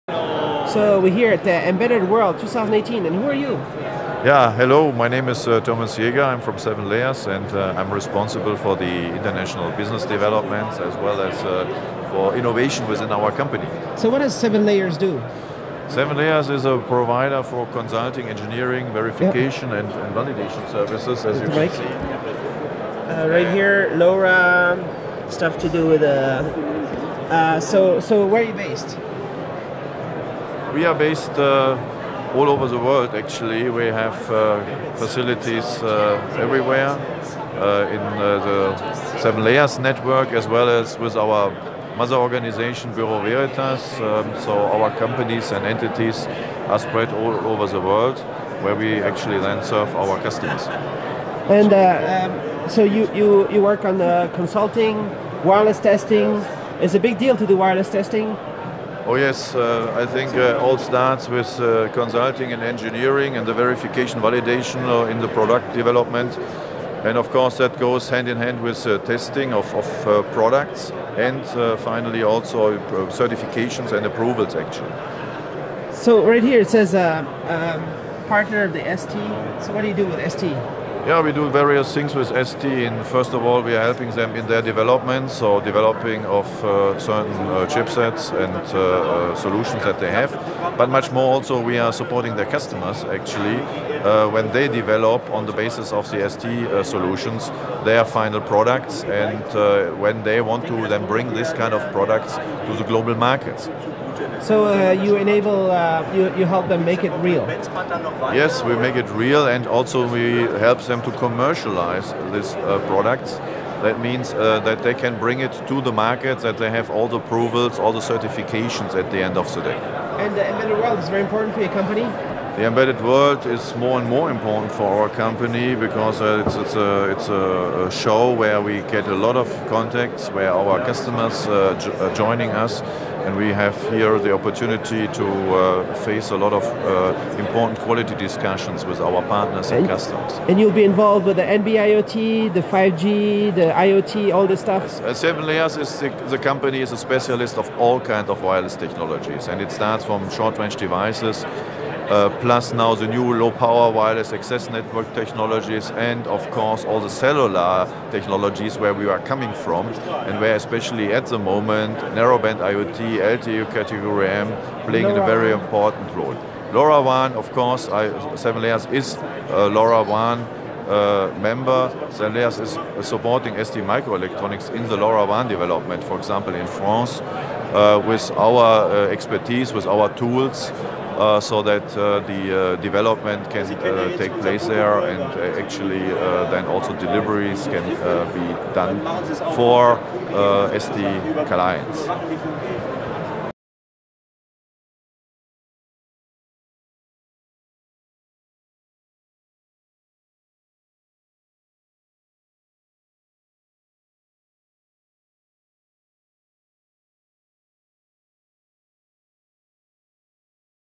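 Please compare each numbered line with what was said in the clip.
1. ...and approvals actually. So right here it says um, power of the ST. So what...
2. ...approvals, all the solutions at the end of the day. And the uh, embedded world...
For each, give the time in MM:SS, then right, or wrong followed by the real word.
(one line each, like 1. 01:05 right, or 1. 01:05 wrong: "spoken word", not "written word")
1. 01:13 wrong: "partner", not "power"
2. 01:57 wrong: "certifications", not "solutions".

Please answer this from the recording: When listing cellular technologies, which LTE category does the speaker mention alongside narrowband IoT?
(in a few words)
Category M.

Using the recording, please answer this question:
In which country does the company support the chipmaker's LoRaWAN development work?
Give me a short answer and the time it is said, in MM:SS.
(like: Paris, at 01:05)
France, at 02:56.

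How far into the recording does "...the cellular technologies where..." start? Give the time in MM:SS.
02:36.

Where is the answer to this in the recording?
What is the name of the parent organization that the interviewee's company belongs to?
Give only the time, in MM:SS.
00:42.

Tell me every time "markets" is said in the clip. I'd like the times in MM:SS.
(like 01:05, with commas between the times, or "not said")
01:43, 01:55.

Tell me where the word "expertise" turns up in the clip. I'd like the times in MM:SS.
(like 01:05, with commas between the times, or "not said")
02:59.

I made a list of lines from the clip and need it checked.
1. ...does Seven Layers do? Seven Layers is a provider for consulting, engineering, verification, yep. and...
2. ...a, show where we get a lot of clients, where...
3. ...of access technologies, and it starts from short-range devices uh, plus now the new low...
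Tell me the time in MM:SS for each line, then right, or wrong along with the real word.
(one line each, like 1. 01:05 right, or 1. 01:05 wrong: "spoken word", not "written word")
1. 00:14 right
2. 02:07 wrong: "contacts", not "clients"
3. 02:28 wrong: "wireless", not "access".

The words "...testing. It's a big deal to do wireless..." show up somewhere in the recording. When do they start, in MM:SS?
00:55.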